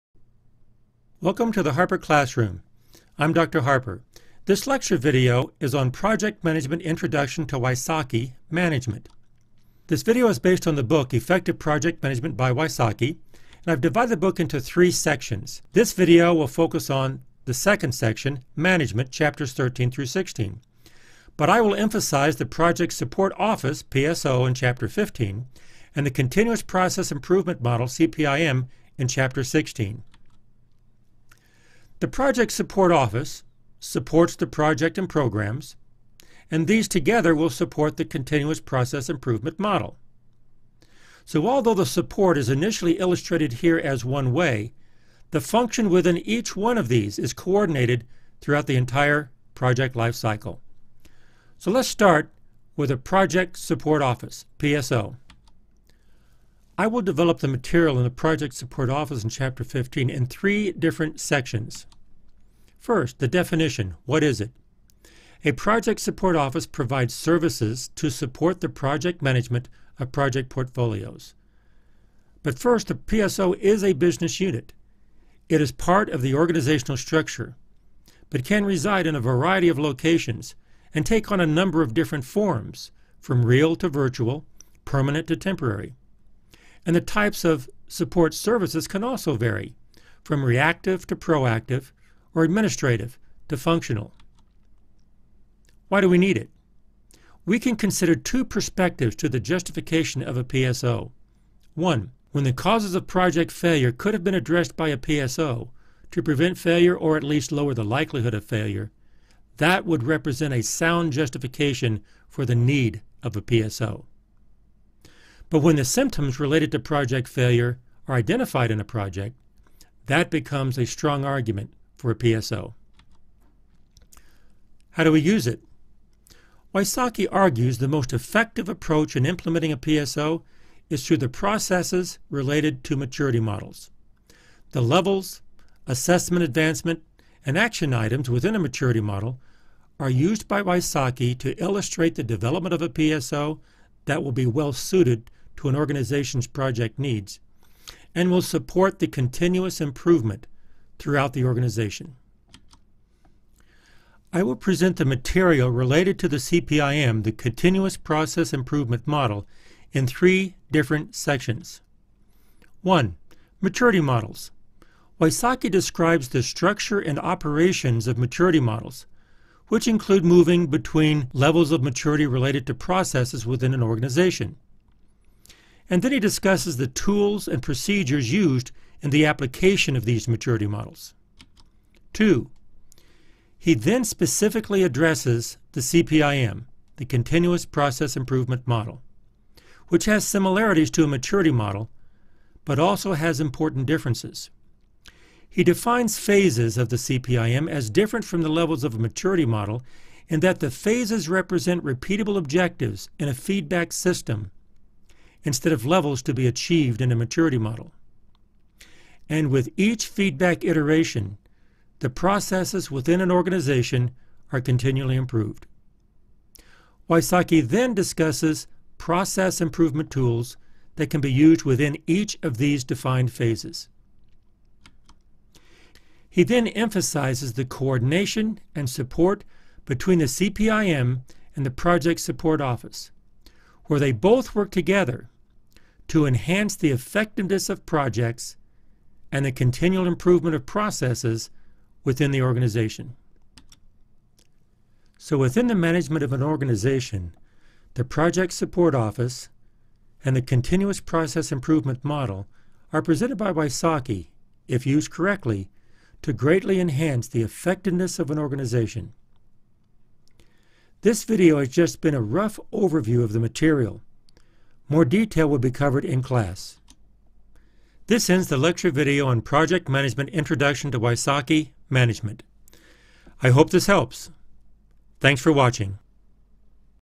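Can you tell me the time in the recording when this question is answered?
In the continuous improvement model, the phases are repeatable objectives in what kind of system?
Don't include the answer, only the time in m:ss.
3:23.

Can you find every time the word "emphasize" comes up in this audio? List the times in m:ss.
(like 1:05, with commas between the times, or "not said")
0:21, 3:46.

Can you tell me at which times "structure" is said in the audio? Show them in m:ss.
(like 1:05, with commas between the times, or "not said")
1:16, 2:46.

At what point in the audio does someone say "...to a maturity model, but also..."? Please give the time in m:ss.
3:10.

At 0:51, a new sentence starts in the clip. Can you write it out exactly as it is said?
So let's start with a Project Support Office, PSO.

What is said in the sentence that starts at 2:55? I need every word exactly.
And then he discusses the tools and procedures used in the application of these maturity models.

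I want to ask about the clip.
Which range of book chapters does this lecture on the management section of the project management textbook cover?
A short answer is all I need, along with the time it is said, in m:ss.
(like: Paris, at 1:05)
13 through 16, at 0:19.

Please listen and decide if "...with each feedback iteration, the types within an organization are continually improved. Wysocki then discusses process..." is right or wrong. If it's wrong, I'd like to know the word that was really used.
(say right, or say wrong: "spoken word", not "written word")
wrong: "processes", not "types".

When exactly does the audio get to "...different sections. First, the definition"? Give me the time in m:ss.
1:00.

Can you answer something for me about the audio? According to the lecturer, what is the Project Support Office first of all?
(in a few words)
business unit.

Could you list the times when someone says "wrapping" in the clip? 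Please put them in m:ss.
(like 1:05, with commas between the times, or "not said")
not said.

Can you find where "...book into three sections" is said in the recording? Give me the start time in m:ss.
0:14.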